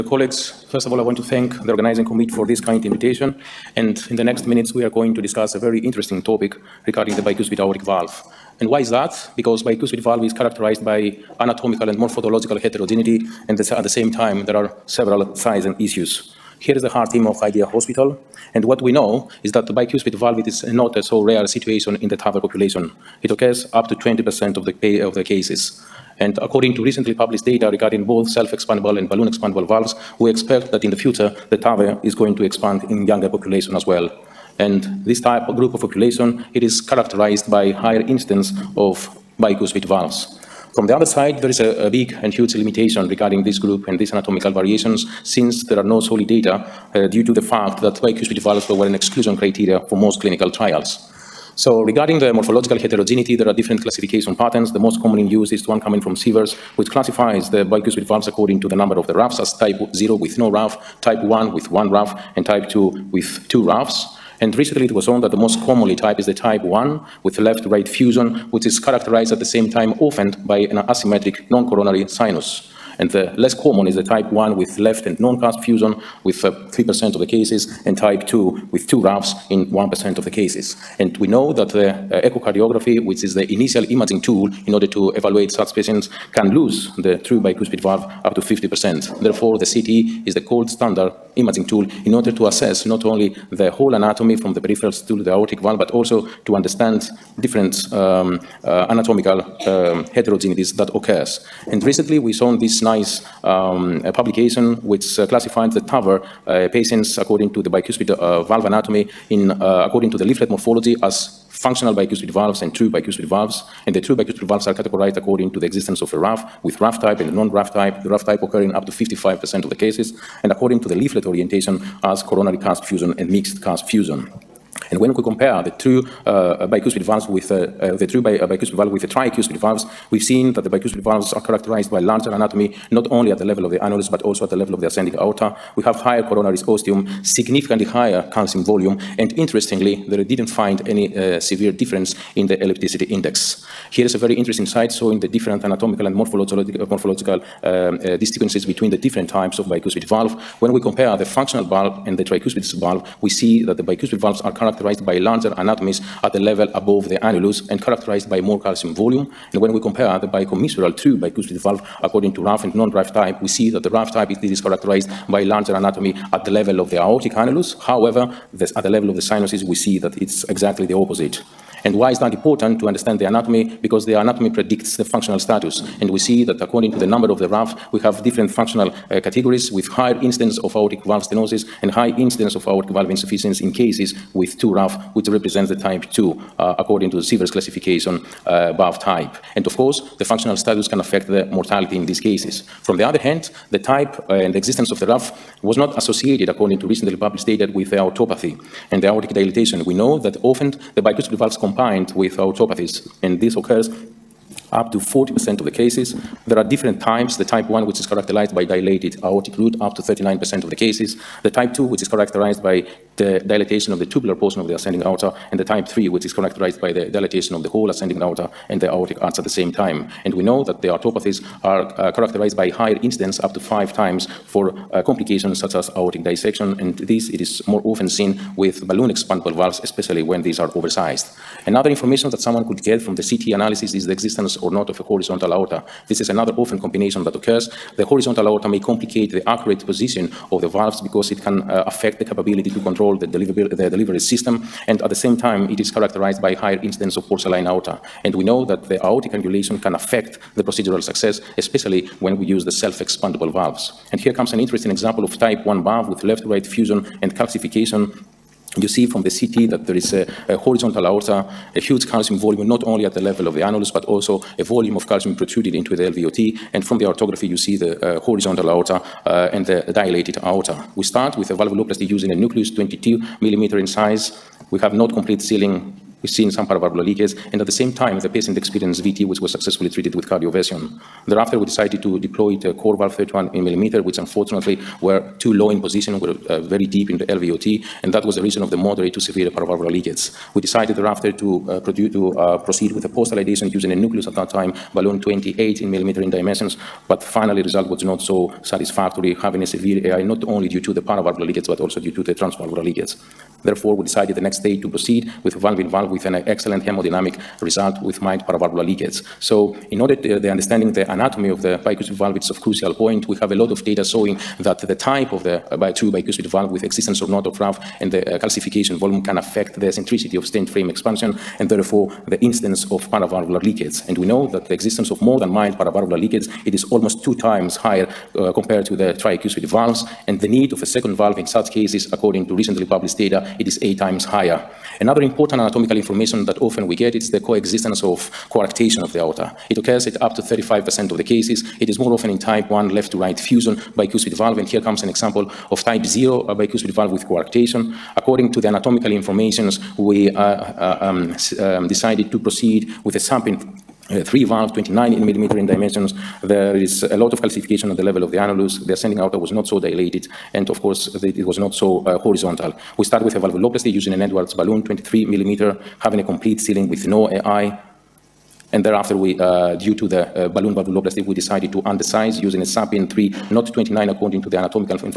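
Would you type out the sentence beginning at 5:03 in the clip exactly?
Therefore, we decided the next day to proceed with valve in valve with an excellent hemodynamic result with mild paravalvular leakage.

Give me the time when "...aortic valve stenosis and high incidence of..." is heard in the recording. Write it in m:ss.
3:00.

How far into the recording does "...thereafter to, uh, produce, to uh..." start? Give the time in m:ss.
4:50.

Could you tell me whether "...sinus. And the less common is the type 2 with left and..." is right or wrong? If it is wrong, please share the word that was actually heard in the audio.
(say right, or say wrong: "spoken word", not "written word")
wrong: "1", not "2".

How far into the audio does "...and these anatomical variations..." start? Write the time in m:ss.
0:43.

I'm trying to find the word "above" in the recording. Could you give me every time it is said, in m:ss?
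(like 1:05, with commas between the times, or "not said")
2:36, 3:08.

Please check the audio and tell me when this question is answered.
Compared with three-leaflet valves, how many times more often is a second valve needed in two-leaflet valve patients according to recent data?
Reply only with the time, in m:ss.
5:33.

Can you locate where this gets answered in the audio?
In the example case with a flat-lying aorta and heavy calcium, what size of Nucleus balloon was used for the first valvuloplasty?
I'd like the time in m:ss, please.
4:32.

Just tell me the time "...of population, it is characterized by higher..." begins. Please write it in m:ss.
0:35.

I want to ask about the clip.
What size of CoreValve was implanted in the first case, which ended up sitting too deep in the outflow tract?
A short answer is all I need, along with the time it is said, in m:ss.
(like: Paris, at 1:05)
31 millimeter, at 4:43.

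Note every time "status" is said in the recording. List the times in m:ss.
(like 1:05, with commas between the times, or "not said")
2:55, 3:10.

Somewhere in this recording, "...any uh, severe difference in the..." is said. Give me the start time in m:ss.
2:20.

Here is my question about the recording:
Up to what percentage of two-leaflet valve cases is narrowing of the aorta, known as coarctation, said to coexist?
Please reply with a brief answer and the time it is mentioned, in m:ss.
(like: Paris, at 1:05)
35%, at 5:40.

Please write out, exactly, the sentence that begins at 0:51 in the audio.
So regarding the morphological heterogeneity, there are different classification patterns.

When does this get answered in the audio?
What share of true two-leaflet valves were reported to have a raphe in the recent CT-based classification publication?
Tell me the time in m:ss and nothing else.
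1:58.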